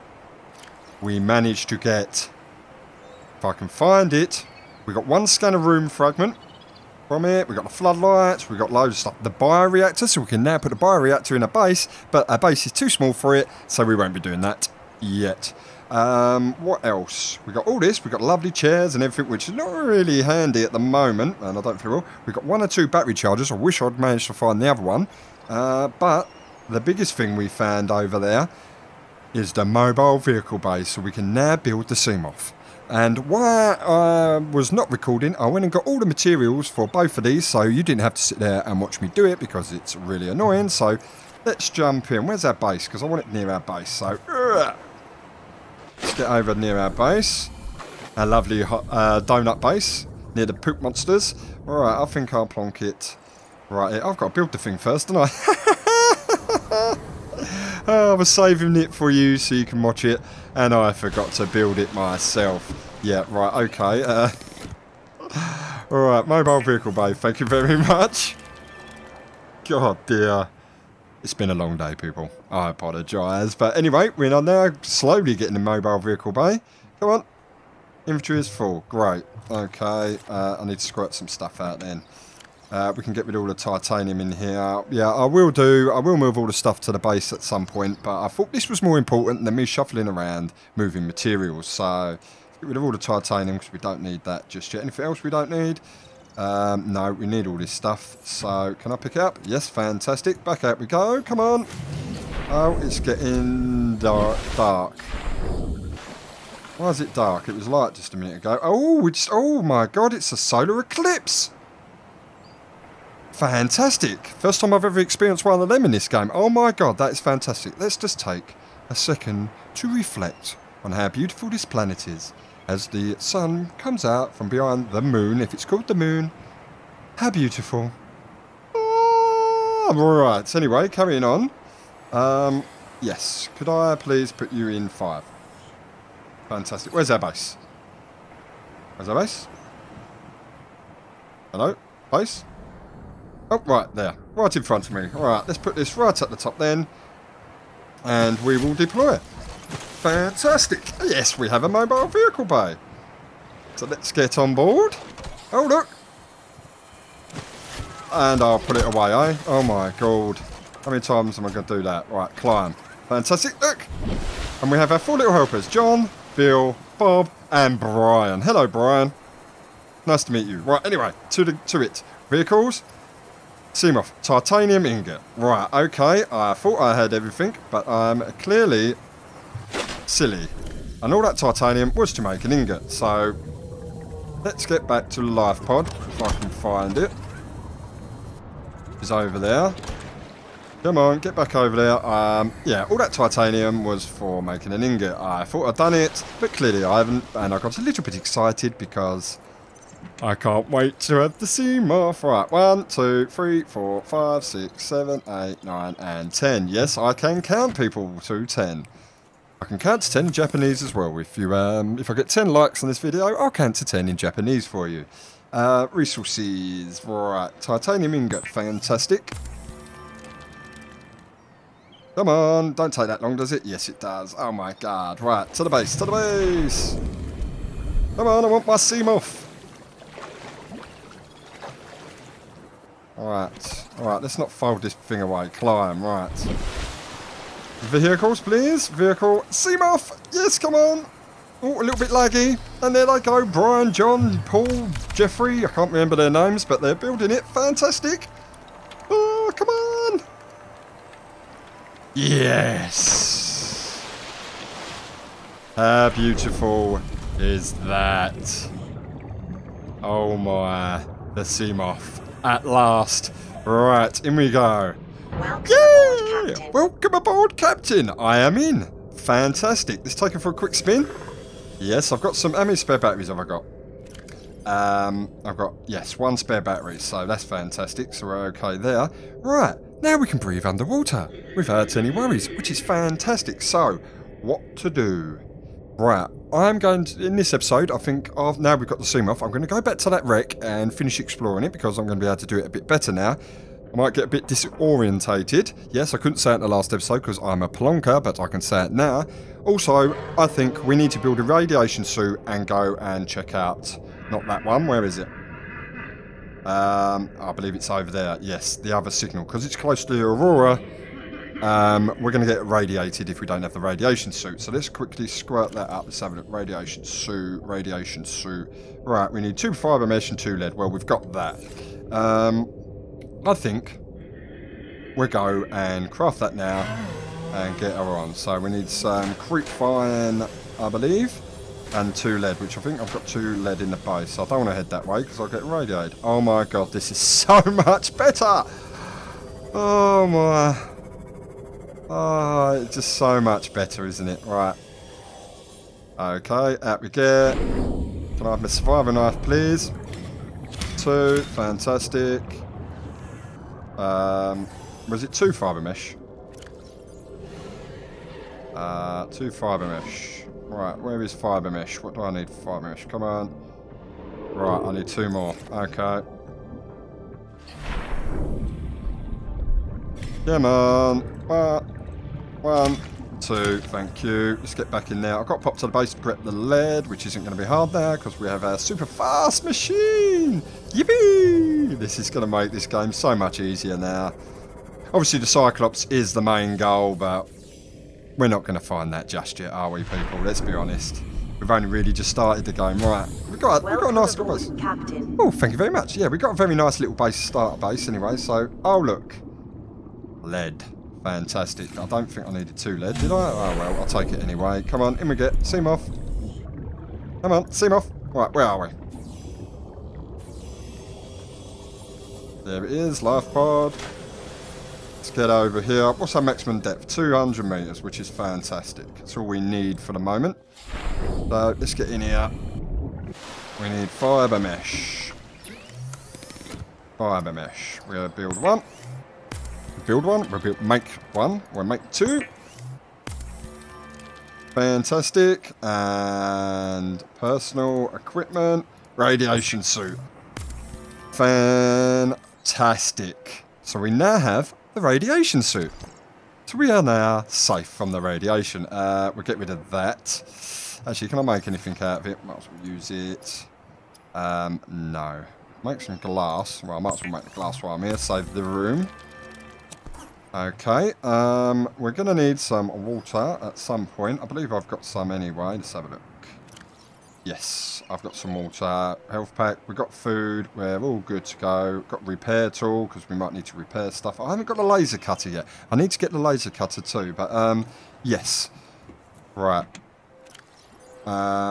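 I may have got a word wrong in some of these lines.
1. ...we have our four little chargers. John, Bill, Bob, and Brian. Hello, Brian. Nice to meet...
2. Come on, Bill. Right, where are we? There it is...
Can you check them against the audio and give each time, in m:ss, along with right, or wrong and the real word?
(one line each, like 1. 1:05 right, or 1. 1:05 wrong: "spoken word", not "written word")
1. 2:44 wrong: "helpers", not "chargers"
2. 6:47 wrong: "Seamoth", not "Bill".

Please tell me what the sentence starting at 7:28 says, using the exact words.
Uh, we'll get rid of that.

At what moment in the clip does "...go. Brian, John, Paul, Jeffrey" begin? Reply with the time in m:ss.
4:03.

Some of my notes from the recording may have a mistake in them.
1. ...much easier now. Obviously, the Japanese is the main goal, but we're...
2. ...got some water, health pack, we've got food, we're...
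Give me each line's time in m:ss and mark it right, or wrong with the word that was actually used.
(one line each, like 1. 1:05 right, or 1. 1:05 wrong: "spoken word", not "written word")
1. 6:23 wrong: "Cyclops", not "Japanese"
2. 7:48 right.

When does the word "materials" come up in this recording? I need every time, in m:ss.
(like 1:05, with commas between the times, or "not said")
0:36, 1:31.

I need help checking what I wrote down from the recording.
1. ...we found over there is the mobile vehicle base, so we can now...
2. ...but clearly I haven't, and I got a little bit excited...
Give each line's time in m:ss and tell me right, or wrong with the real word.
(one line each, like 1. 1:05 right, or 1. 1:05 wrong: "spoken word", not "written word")
1. 0:27 right
2. 3:16 right.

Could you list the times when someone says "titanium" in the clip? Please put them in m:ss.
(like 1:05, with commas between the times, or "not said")
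1:23, 1:32, 2:54, 3:01, 3:13, 3:37.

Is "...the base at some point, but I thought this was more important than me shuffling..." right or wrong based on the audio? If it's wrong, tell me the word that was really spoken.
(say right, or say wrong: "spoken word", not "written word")
right.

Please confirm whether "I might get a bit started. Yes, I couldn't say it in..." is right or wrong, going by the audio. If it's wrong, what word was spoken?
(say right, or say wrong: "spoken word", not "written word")
wrong: "disorientated", not "started".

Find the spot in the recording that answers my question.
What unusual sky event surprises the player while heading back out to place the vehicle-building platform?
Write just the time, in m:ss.
1:50.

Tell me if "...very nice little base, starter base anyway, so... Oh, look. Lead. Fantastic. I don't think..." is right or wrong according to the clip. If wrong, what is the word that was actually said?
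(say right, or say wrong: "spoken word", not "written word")
right.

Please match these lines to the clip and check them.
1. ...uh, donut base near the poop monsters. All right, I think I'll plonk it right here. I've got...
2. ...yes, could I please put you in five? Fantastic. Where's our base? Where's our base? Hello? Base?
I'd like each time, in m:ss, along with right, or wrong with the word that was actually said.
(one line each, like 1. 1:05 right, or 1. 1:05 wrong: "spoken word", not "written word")
1. 0:48 right
2. 2:13 right.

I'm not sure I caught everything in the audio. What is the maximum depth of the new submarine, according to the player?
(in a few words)
200 metres.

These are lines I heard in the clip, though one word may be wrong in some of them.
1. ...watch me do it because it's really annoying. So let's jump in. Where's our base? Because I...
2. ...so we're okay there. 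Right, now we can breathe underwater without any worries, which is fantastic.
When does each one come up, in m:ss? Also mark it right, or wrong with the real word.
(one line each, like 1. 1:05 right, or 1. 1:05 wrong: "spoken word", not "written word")
1. 0:38 right
2. 4:38 right.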